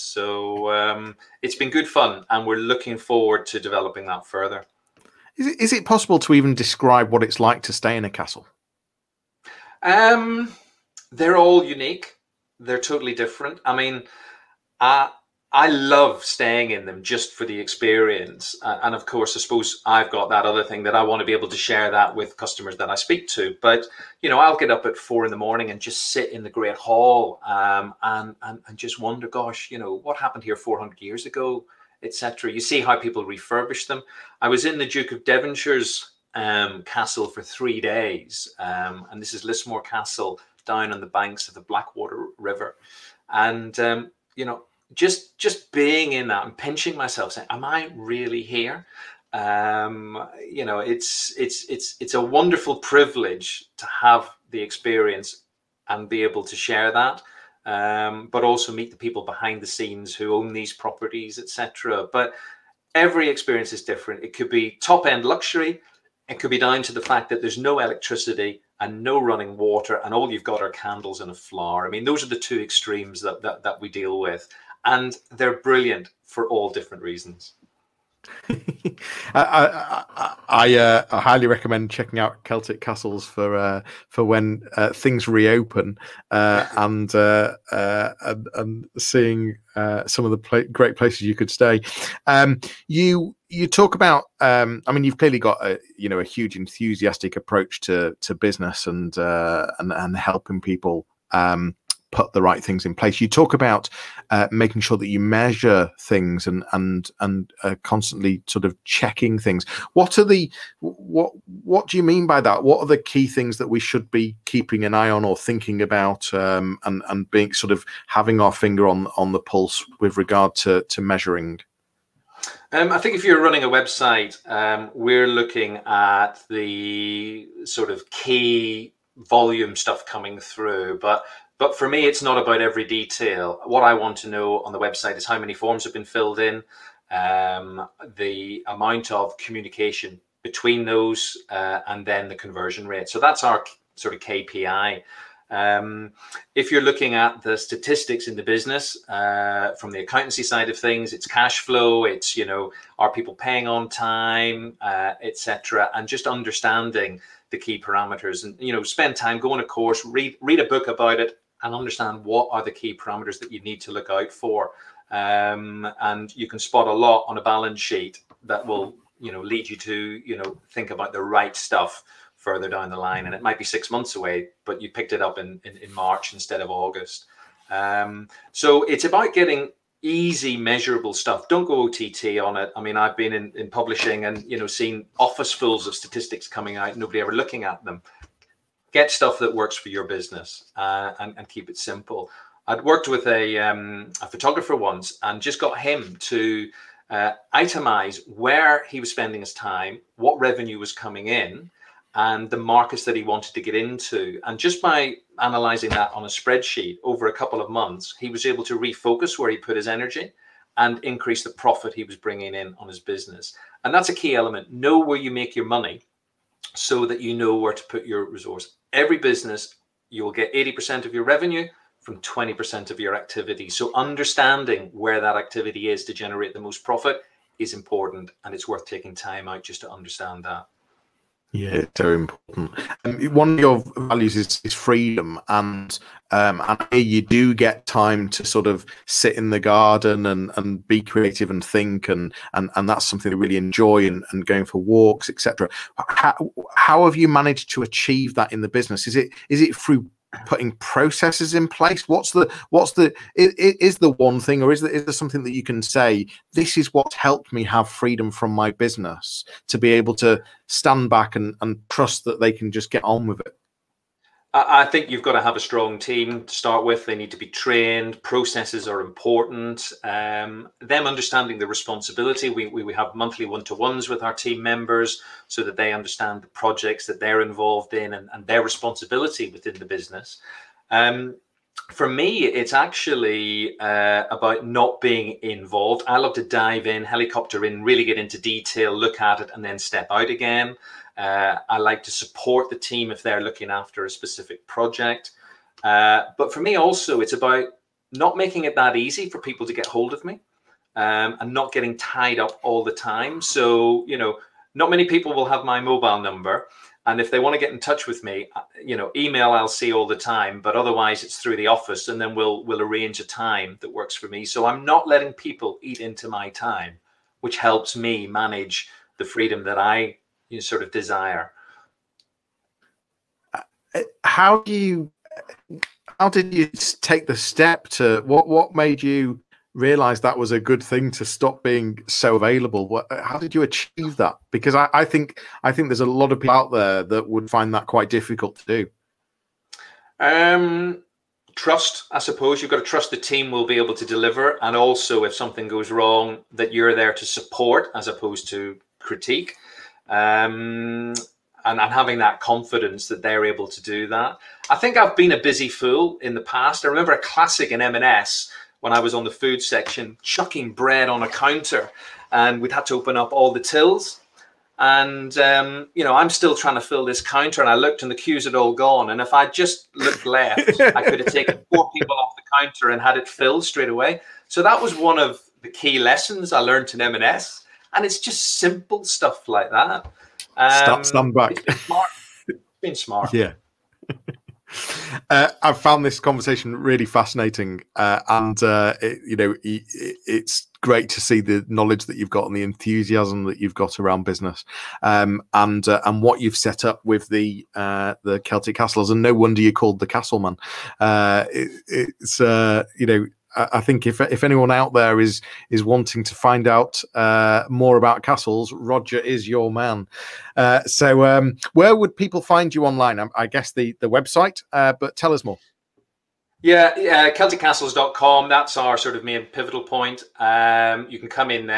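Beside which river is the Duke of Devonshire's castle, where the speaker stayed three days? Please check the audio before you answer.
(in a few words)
Blackwater River.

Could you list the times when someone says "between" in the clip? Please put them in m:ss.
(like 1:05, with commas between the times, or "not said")
2:20.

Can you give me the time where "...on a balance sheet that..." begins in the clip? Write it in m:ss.
2:47.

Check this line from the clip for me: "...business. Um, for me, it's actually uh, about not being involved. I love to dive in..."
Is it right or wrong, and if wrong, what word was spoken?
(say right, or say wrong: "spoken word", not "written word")
right.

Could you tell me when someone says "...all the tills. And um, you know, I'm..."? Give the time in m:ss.
6:03.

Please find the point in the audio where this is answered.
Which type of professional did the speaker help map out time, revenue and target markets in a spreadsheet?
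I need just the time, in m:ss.
3:14.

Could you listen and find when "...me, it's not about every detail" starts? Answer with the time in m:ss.
2:11.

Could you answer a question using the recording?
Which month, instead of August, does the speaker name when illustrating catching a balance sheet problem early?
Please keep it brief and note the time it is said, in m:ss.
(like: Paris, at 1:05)
March, at 2:55.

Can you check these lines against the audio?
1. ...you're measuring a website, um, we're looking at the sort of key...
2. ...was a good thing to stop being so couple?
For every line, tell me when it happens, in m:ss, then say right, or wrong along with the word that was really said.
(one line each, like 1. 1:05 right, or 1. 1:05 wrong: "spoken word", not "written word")
1. 2:03 wrong: "running", not "measuring"
2. 5:30 wrong: "available", not "couple".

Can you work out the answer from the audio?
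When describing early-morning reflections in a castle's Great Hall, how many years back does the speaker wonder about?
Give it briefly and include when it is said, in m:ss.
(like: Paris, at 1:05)
400, at 0:30.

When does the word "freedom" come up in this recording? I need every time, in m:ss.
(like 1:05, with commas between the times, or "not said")
3:54, 4:17, 5:19.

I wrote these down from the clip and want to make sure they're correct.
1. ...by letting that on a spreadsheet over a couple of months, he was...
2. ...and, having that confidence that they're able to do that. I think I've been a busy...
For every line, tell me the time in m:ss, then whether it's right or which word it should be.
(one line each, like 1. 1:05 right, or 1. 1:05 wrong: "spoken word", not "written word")
1. 3:24 wrong: "analyzing", not "letting"
2. 5:51 right.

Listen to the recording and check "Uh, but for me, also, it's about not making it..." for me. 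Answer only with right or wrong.
right.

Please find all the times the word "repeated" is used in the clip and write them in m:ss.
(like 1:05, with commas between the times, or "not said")
not said.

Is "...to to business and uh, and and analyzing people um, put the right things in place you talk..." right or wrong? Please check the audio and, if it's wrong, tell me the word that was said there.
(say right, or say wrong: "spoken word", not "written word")
wrong: "helping", not "analyzing".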